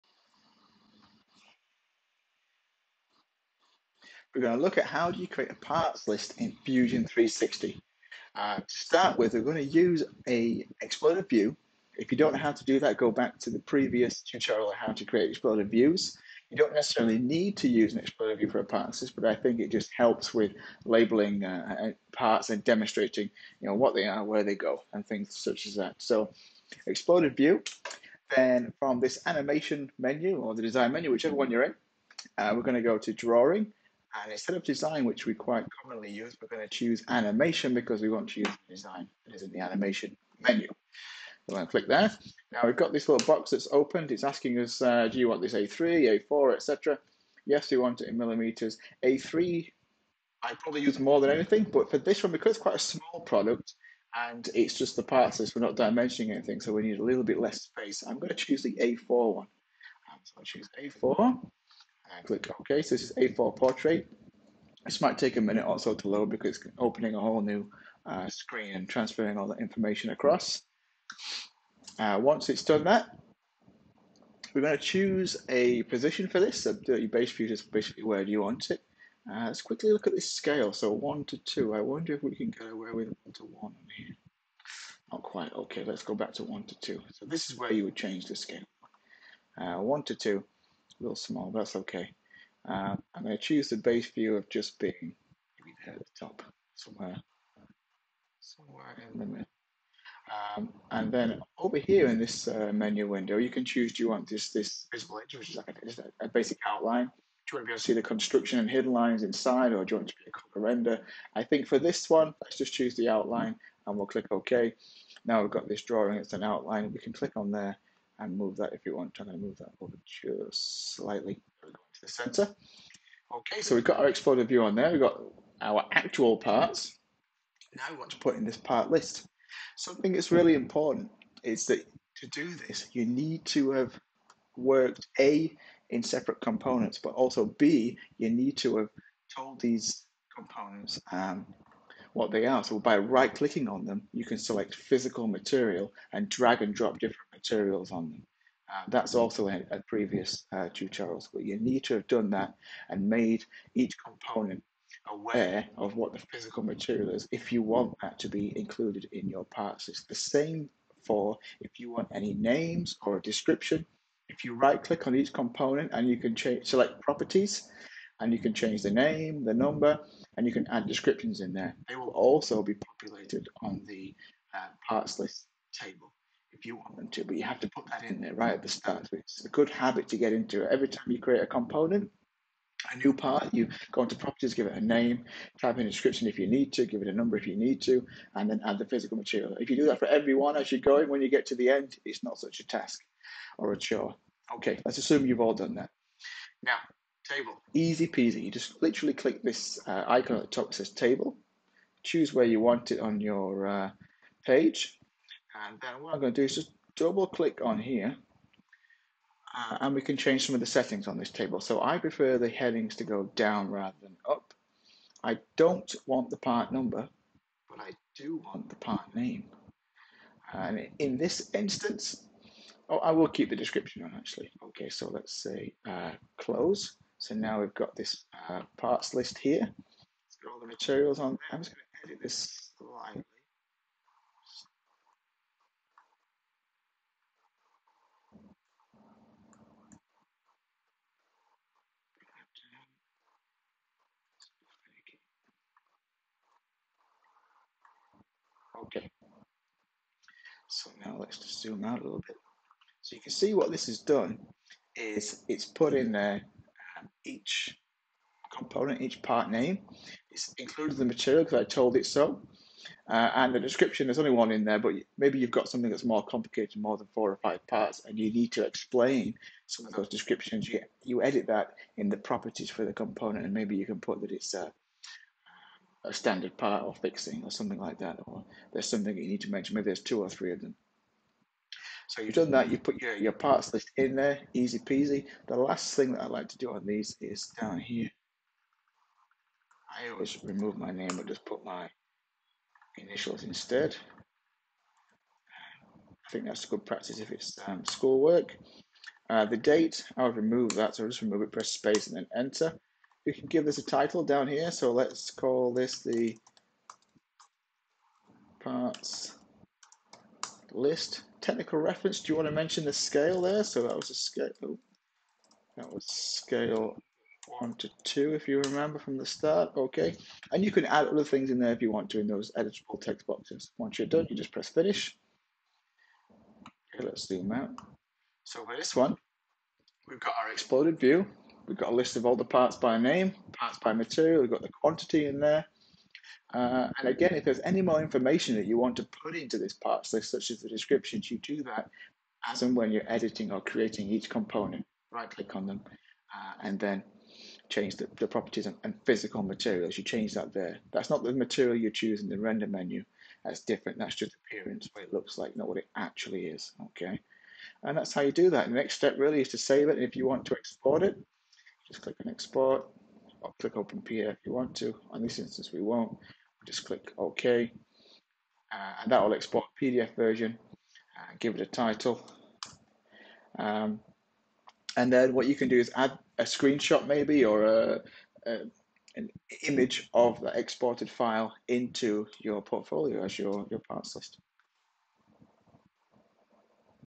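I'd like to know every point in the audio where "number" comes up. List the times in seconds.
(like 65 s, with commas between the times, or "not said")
169 s, 187 s, 216 s.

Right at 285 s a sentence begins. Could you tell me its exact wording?
The last thing that I like to do on these is down here.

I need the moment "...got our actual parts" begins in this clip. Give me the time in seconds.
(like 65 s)
125 s.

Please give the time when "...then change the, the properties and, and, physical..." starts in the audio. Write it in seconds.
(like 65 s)
346 s.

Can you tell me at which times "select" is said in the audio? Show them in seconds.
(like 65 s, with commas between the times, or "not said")
144 s, 166 s.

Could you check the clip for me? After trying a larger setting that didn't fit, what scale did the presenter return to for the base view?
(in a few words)
1:2.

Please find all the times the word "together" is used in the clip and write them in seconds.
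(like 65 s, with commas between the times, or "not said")
not said.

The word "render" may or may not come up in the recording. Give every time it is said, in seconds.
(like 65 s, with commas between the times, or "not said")
110 s, 352 s.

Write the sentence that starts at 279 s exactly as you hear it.
Maybe there's two or three of them.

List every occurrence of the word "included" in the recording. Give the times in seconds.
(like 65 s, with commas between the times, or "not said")
158 s, 260 s.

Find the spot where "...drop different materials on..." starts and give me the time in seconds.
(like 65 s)
146 s.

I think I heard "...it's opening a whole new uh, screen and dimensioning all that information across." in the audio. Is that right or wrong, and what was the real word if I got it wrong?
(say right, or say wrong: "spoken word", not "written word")
wrong: "transferring", not "dimensioning".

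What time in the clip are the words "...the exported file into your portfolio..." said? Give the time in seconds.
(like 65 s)
380 s.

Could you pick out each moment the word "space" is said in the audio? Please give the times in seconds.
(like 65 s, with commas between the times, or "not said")
57 s, 301 s.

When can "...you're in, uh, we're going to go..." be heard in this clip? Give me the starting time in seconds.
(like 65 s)
31 s.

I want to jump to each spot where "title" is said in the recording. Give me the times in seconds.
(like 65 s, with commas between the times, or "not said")
303 s, 371 s.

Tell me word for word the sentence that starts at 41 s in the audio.
So i going to click there.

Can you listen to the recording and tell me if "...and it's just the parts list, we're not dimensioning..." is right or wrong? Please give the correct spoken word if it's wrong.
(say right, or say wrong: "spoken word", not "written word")
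right.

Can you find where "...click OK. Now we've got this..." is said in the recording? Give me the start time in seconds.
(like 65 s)
114 s.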